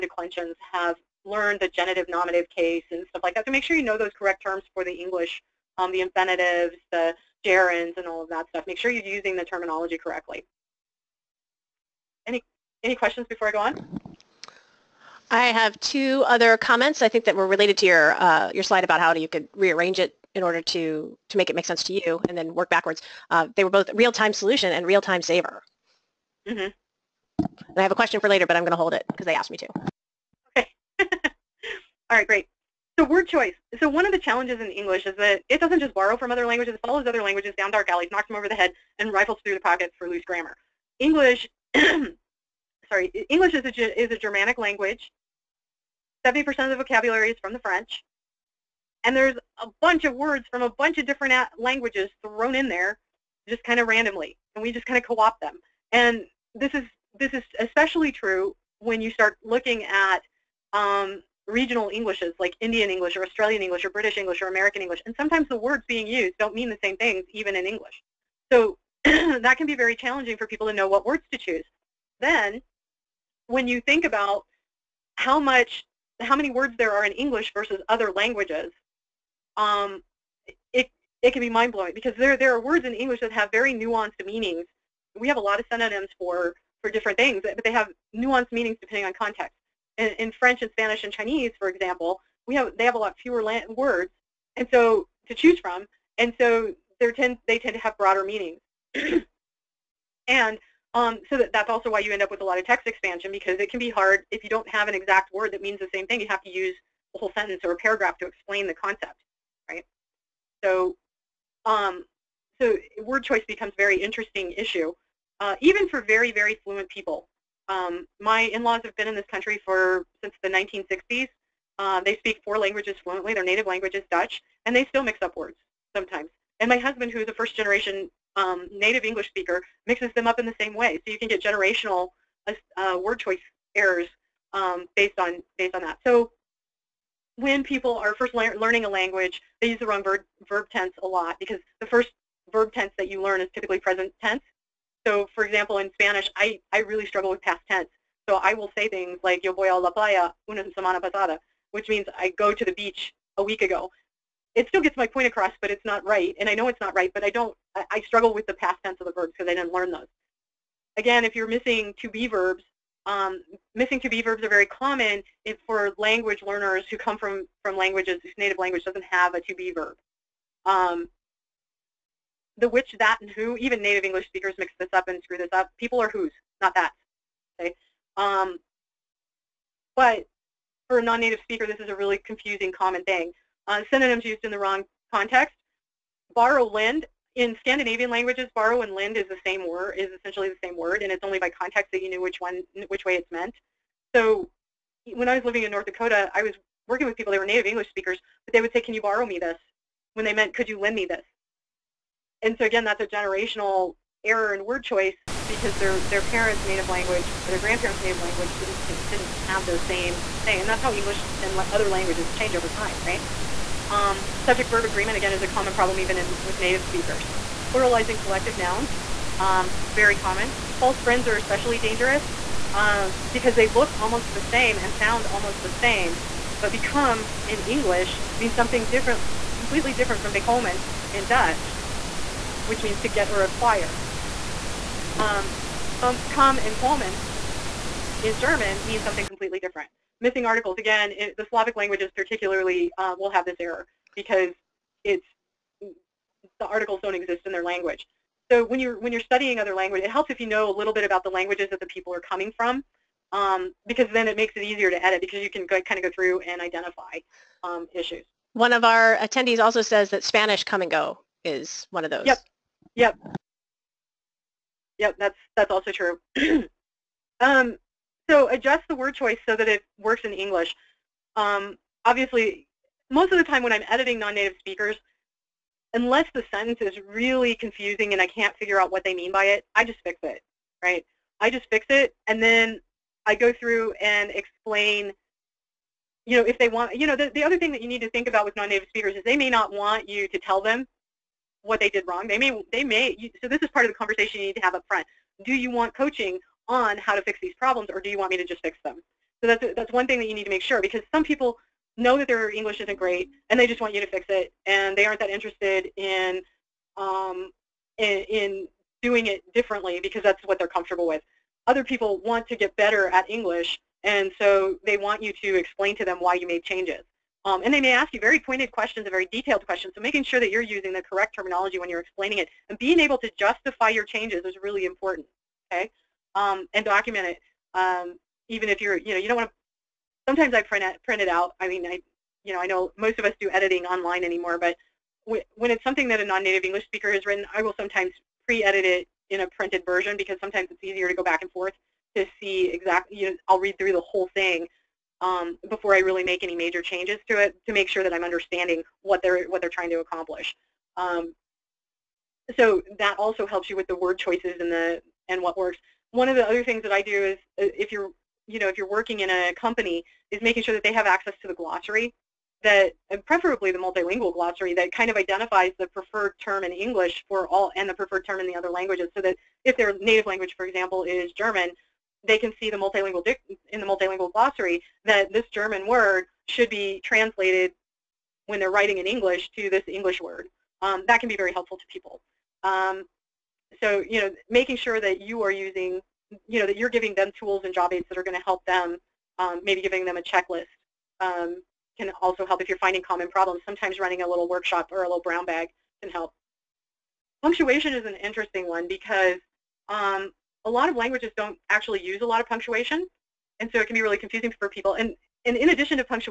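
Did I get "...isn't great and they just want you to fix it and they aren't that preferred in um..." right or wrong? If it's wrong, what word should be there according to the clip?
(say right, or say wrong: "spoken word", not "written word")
wrong: "interested", not "preferred".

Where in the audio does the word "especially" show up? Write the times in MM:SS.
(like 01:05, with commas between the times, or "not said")
00:57, 03:41.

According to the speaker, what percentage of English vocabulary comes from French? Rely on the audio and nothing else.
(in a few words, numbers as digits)
70%.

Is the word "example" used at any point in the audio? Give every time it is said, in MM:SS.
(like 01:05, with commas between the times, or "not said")
01:31, 02:25, 06:10.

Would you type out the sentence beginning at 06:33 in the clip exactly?
Sometimes running a little workshop or a little brown bag can help.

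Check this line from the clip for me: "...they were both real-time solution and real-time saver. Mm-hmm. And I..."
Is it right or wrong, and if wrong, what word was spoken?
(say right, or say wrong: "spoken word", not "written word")
right.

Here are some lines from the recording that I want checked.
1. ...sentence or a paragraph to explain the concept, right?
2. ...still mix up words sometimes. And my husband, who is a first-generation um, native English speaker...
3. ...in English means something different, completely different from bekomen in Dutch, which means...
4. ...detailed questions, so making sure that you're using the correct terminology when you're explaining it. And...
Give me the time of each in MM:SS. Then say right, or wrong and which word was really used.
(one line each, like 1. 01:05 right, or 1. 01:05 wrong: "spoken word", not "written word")
1. 01:47 right
2. 02:04 right
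3. 03:47 right
4. 05:19 right.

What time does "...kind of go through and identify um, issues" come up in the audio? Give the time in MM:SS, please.
04:15.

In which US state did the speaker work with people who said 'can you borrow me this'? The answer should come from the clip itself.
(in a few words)
North Dakota.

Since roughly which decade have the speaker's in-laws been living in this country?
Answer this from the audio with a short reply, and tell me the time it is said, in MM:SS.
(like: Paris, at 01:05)
1960s, at 02:00.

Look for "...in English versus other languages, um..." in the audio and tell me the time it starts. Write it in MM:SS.
01:17.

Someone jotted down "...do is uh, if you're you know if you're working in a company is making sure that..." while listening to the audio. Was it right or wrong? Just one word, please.
right.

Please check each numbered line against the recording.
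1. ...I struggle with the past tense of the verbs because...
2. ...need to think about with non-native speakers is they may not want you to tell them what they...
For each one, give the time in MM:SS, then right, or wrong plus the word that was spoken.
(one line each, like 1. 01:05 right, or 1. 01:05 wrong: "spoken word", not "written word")
1. 02:37 right
2. 04:47 right.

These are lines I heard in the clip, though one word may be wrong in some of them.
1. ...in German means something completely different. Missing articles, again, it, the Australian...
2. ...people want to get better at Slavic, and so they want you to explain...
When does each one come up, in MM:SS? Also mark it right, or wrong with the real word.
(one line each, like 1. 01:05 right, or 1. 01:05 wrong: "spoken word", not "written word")
1. 03:58 wrong: "Slavic", not "Australian"
2. 05:11 wrong: "English", not "Slavic".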